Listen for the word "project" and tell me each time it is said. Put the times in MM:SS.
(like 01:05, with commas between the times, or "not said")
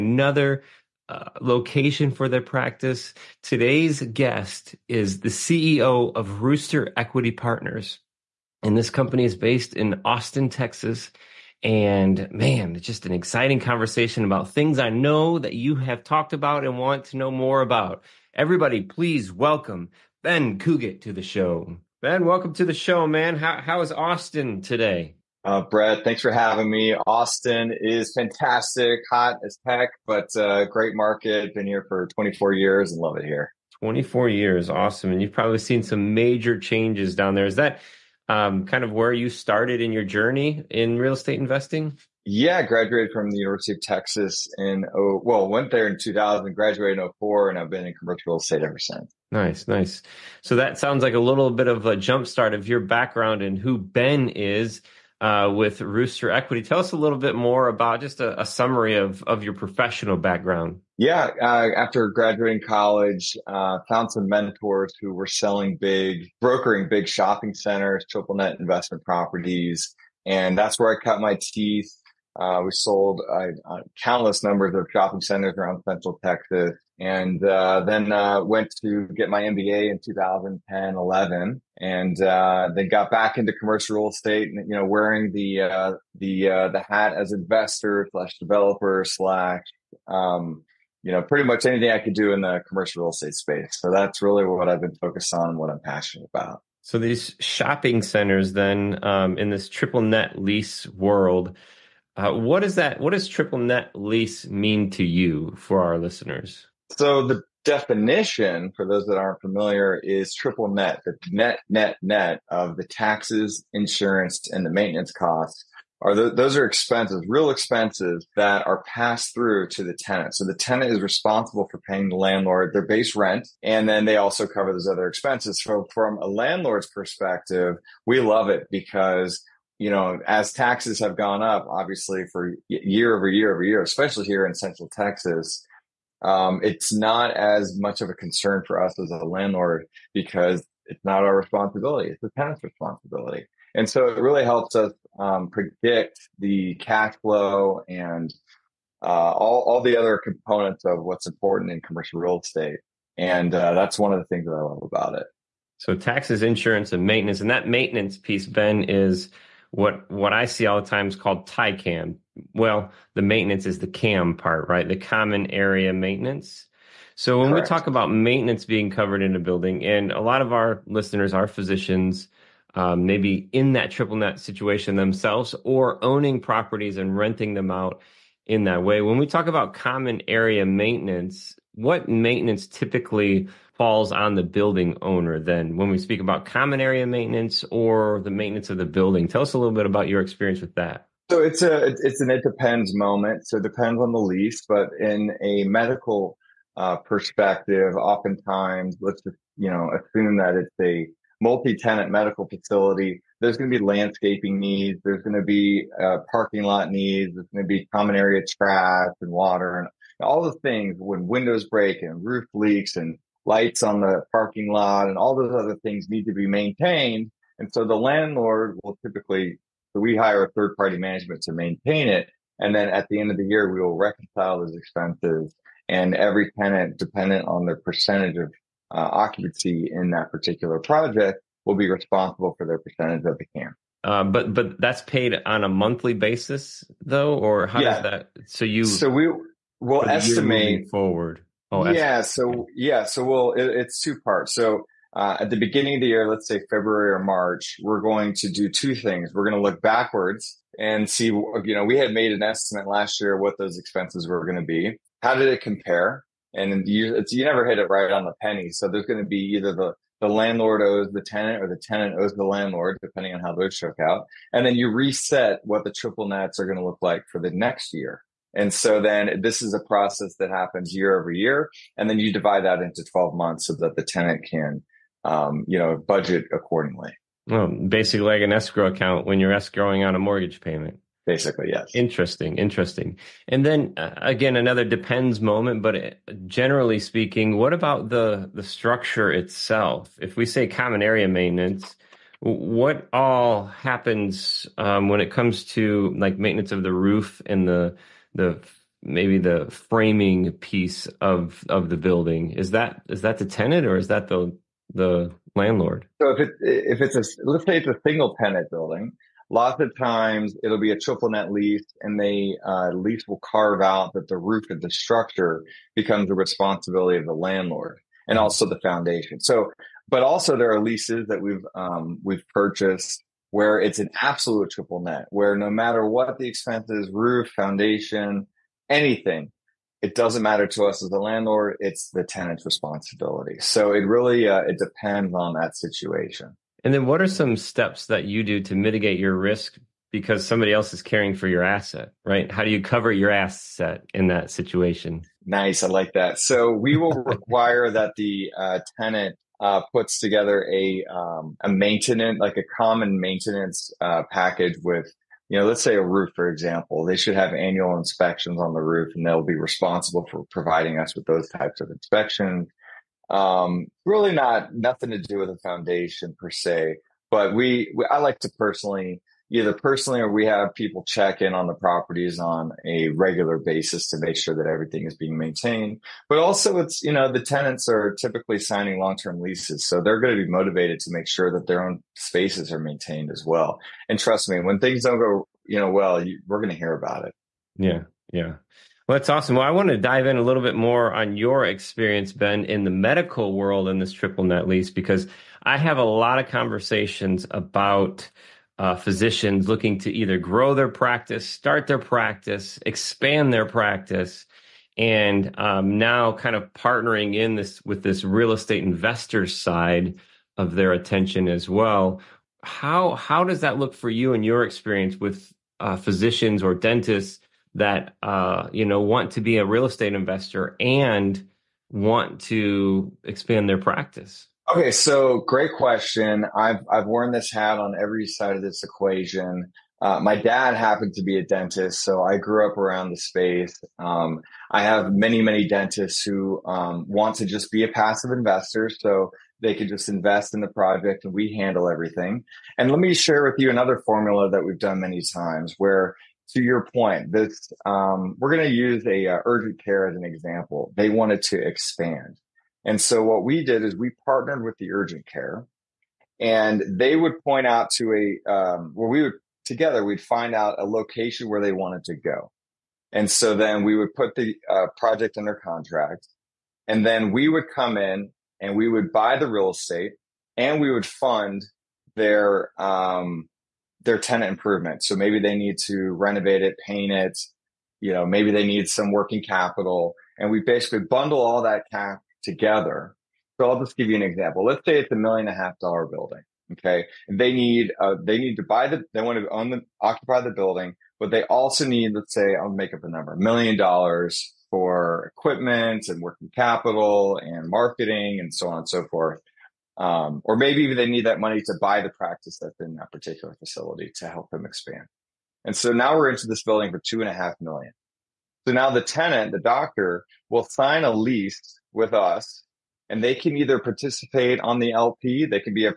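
03:50, 07:20, 07:44.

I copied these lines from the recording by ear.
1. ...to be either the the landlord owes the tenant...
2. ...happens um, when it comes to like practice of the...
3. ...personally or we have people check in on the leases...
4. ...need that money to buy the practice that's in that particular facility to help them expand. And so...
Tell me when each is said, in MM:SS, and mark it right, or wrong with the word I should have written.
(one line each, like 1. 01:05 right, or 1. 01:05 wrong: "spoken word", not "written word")
1. 04:19 right
2. 04:53 wrong: "maintenance", not "practice"
3. 06:09 wrong: "properties", not "leases"
4. 08:21 right.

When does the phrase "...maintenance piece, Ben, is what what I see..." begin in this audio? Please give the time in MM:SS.
02:37.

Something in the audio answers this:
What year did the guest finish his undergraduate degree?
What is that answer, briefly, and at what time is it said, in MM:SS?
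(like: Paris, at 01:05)
2004, at 00:46.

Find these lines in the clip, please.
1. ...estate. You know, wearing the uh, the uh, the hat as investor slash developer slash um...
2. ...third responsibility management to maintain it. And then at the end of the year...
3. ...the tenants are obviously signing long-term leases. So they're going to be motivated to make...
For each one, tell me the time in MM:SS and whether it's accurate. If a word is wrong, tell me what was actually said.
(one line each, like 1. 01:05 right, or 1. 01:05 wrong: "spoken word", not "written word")
1. 01:24 right
2. 03:40 wrong: "party", not "responsibility"
3. 06:17 wrong: "typically", not "obviously".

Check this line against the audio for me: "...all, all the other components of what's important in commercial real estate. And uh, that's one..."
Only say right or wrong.
right.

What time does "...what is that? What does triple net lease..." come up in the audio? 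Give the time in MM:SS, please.
01:42.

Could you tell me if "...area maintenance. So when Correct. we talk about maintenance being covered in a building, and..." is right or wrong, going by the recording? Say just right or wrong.
right.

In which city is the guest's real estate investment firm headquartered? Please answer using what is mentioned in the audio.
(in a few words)
Austin, Texas.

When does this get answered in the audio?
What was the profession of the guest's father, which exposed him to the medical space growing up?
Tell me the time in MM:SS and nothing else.
07:11.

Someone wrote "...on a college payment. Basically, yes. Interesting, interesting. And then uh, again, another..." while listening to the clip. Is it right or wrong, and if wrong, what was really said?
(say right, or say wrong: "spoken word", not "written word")
wrong: "mortgage", not "college".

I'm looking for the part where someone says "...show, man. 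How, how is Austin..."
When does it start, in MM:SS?
00:22.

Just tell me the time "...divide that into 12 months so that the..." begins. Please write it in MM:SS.
04:32.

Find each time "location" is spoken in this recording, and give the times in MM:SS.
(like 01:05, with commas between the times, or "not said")
00:01, 07:40.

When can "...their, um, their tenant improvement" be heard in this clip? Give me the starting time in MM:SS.
07:52.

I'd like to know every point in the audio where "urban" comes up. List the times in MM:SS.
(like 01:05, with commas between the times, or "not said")
not said.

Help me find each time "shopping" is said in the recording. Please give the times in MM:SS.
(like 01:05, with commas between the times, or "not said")
01:07, 01:14, 01:37.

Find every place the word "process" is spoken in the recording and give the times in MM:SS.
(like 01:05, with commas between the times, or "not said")
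04:29.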